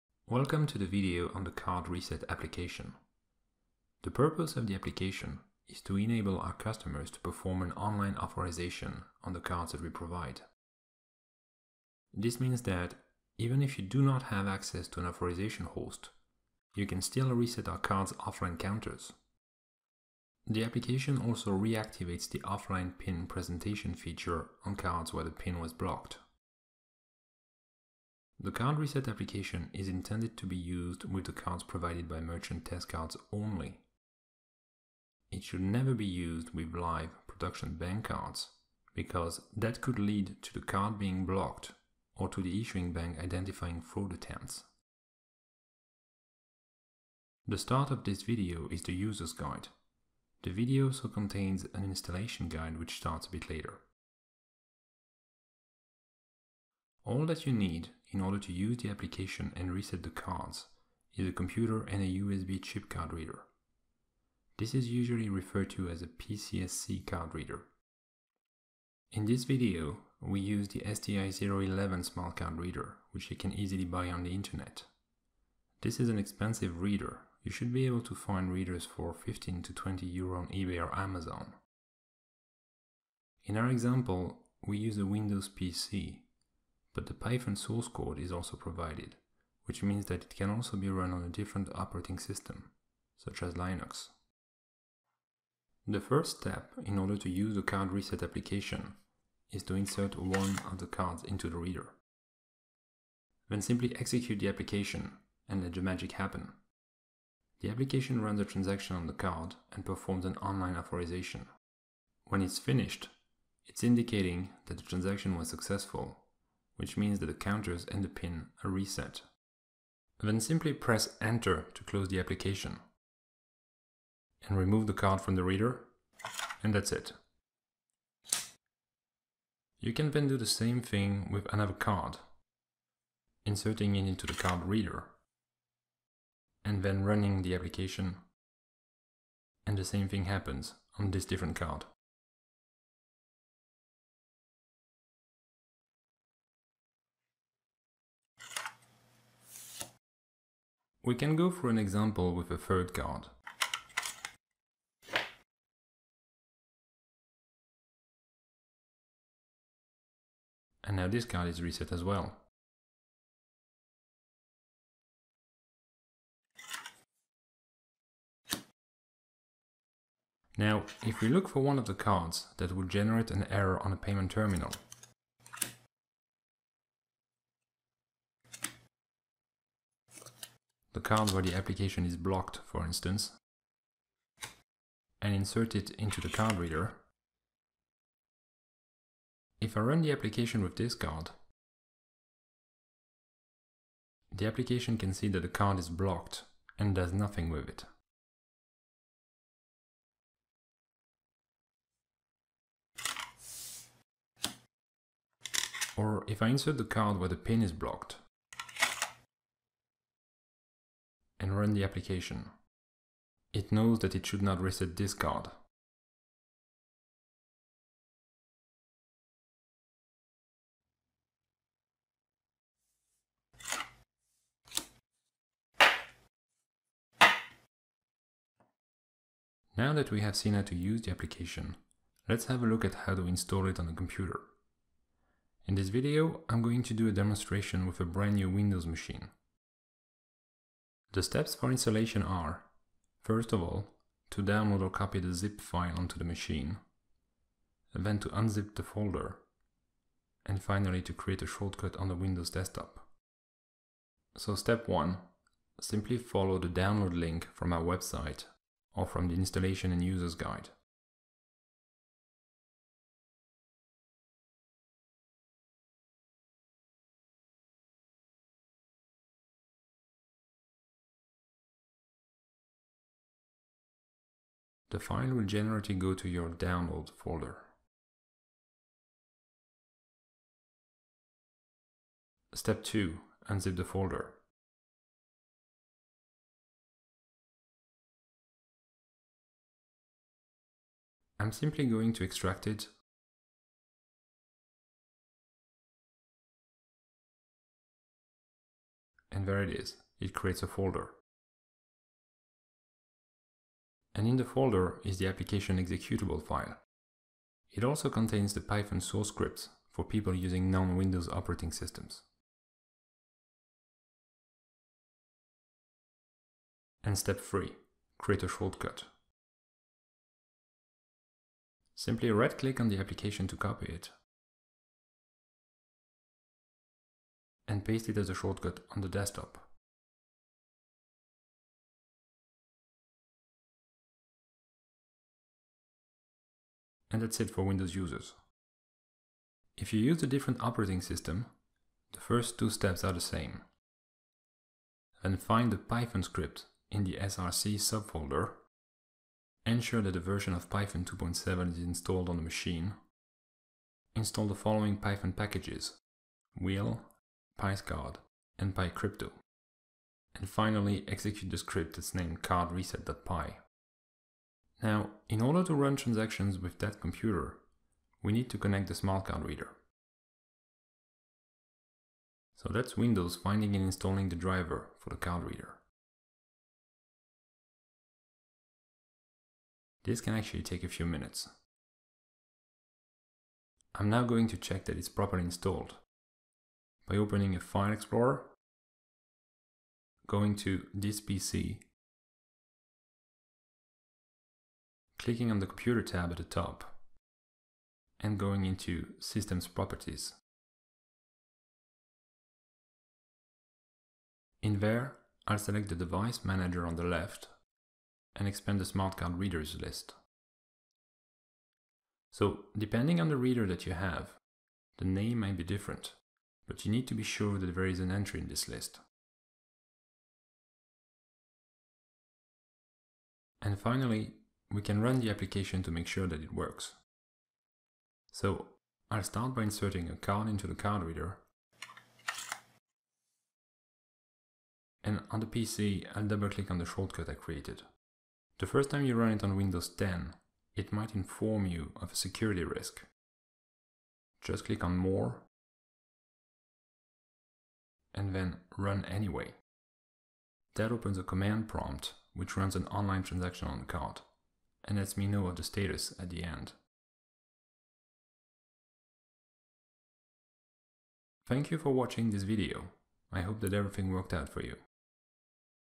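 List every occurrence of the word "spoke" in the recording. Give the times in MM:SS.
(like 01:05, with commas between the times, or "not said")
not said.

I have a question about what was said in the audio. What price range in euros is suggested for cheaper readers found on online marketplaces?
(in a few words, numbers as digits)
15 to 20 euro.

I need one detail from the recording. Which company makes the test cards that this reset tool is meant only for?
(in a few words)
Merchant Test Cards.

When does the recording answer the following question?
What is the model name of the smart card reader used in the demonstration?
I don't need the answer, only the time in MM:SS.
01:10.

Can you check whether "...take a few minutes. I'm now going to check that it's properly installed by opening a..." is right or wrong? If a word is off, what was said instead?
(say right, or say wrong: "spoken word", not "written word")
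right.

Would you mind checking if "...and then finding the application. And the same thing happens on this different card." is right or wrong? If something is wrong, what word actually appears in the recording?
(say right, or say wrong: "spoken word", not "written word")
wrong: "running", not "finding".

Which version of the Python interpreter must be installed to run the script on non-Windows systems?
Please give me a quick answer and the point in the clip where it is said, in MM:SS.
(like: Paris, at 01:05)
2.7, at 05:50.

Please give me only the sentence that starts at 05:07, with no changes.
It also contains the Python source scripts for people using non-Windows operating systems.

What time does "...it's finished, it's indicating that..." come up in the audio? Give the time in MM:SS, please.
01:52.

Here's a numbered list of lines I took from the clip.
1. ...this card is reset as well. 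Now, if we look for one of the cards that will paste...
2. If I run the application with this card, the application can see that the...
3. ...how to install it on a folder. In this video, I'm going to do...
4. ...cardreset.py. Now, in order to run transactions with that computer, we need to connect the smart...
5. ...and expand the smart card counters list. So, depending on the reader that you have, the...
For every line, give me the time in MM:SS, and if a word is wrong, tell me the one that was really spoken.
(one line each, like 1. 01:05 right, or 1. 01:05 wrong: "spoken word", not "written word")
1. 02:41 wrong: "generate", not "paste"
2. 03:09 right
3. 03:52 wrong: "computer", not "folder"
4. 06:02 right
5. 06:48 wrong: "readers", not "counters".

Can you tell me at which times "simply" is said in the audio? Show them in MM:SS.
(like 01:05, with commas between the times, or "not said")
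01:43, 02:00, 04:15, 04:51, 05:21.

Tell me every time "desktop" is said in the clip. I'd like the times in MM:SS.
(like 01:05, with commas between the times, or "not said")
04:12, 05:29.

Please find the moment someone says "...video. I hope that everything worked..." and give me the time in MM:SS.
07:42.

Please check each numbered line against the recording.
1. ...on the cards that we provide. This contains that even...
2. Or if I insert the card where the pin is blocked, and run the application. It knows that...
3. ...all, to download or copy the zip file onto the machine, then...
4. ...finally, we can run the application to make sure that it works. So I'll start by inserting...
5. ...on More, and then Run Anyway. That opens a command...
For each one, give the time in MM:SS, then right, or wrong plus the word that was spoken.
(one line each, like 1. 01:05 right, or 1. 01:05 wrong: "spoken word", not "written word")
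1. 00:09 wrong: "means", not "contains"
2. 03:25 right
3. 04:03 right
4. 07:03 right
5. 07:24 right.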